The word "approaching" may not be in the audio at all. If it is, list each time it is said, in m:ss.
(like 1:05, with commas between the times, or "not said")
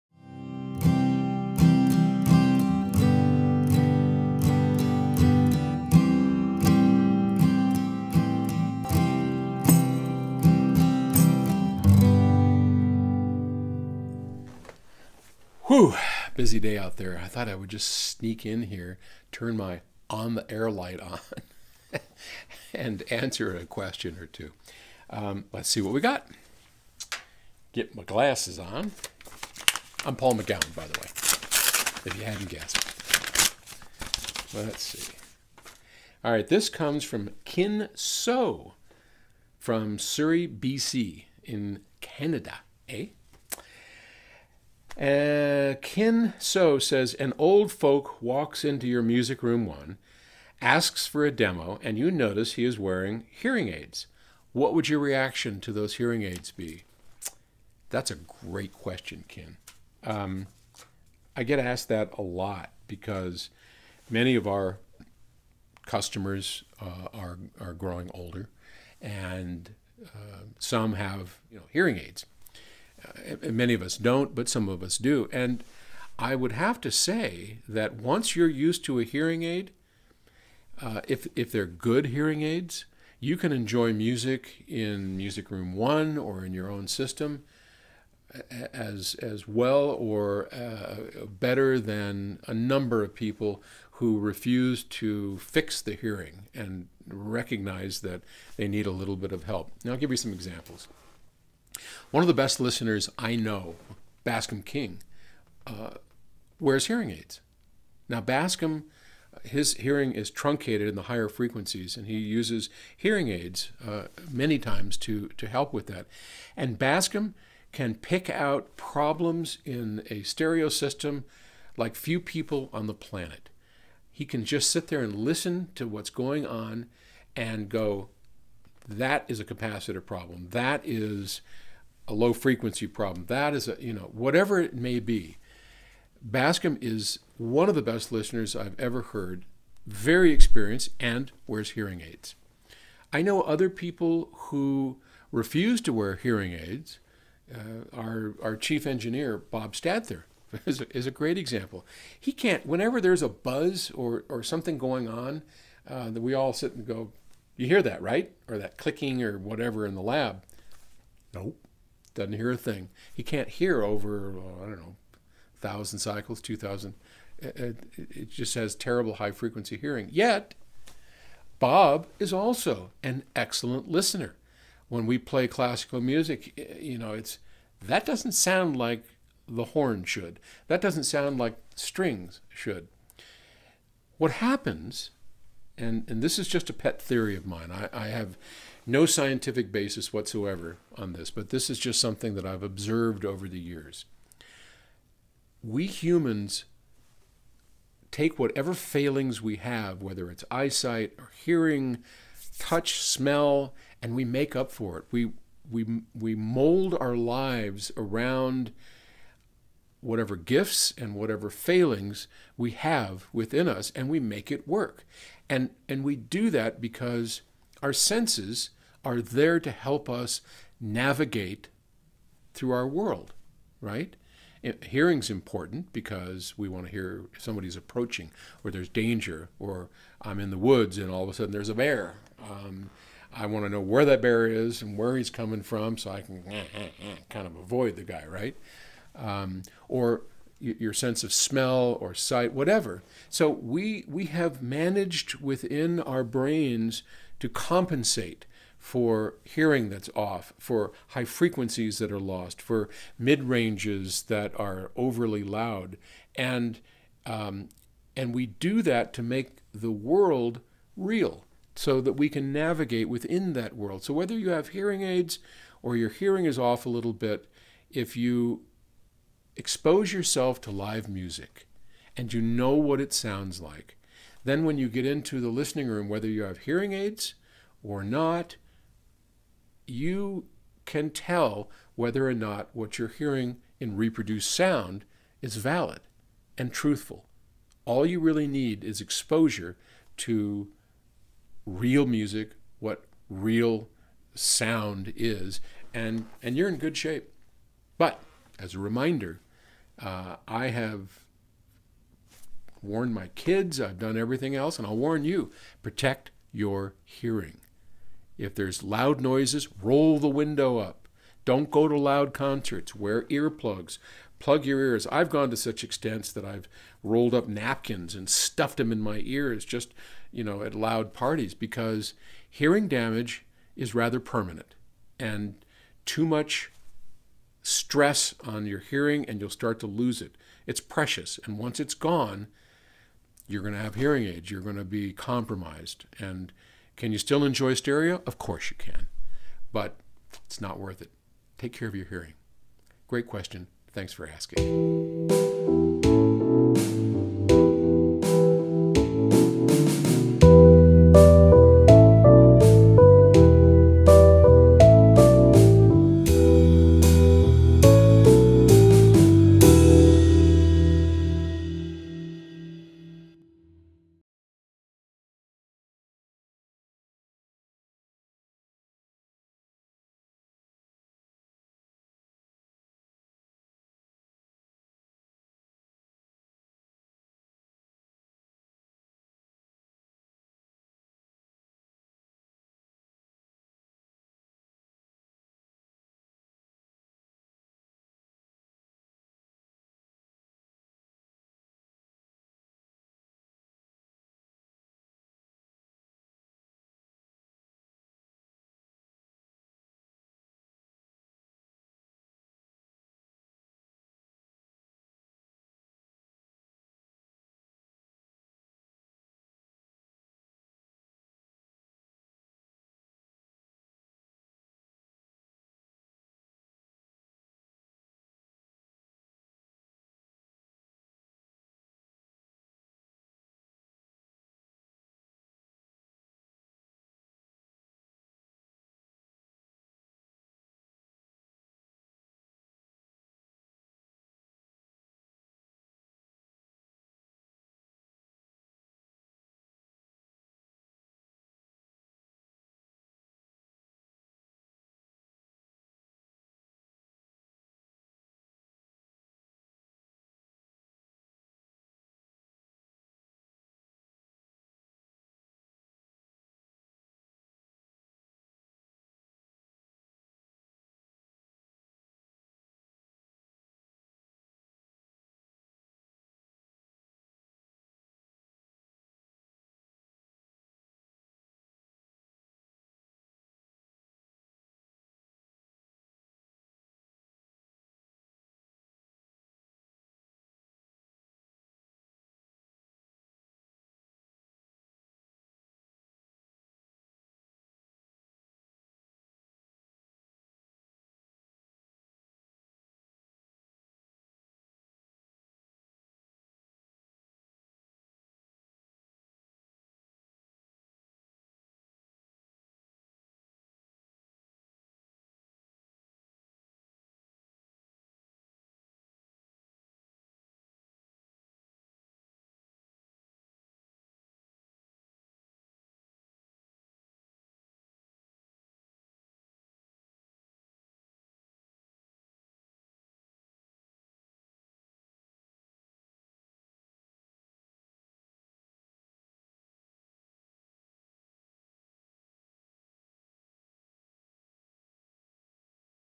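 3:47.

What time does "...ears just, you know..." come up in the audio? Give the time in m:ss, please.
5:19.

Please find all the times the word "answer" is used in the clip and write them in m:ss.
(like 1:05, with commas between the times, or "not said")
0:23.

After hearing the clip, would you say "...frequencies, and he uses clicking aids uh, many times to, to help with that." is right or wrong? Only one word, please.
wrong.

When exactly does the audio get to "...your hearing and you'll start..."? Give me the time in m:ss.
5:28.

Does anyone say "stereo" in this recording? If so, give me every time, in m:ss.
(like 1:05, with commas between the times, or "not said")
2:00, 5:37.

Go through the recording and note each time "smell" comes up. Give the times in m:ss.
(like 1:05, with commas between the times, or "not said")
3:22, 4:01.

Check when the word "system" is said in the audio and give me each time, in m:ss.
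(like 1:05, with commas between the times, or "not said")
1:26, 2:00.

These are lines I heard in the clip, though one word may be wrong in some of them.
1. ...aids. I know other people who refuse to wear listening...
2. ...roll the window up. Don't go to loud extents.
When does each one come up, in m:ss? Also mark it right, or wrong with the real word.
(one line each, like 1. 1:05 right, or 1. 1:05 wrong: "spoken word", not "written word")
1. 2:22 wrong: "hearing", not "listening"
2. 5:09 wrong: "concerts", not "extents".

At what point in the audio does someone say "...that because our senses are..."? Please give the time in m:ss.
3:36.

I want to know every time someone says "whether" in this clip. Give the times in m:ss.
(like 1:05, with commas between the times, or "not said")
3:20, 4:24, 4:36, 4:41.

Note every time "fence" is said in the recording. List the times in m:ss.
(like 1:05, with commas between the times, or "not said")
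not said.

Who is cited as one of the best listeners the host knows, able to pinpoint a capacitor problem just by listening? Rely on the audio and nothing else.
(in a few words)
Bascom King.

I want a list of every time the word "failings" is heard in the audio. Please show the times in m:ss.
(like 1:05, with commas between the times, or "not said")
3:18, 3:31.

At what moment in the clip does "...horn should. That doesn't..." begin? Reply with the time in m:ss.
2:59.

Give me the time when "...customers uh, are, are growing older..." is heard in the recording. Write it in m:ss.
1:05.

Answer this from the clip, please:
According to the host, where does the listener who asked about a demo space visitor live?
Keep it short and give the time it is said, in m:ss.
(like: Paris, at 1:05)
Surrey, BC, at 0:39.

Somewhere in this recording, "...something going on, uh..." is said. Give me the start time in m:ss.
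2:34.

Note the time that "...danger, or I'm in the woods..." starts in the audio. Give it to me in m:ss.
3:48.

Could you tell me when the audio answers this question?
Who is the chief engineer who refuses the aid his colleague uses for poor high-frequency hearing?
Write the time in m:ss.
2:29.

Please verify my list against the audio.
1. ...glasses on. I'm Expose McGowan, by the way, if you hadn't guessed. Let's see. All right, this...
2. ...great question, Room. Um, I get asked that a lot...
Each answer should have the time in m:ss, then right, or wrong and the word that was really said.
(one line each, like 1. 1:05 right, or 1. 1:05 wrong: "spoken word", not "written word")
1. 0:28 wrong: "Paul", not "Expose"
2. 0:58 wrong: "Kin", not "Room".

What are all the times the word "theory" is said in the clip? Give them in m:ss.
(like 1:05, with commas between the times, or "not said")
3:07.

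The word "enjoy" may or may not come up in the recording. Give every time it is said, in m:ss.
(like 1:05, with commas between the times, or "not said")
1:23, 5:37.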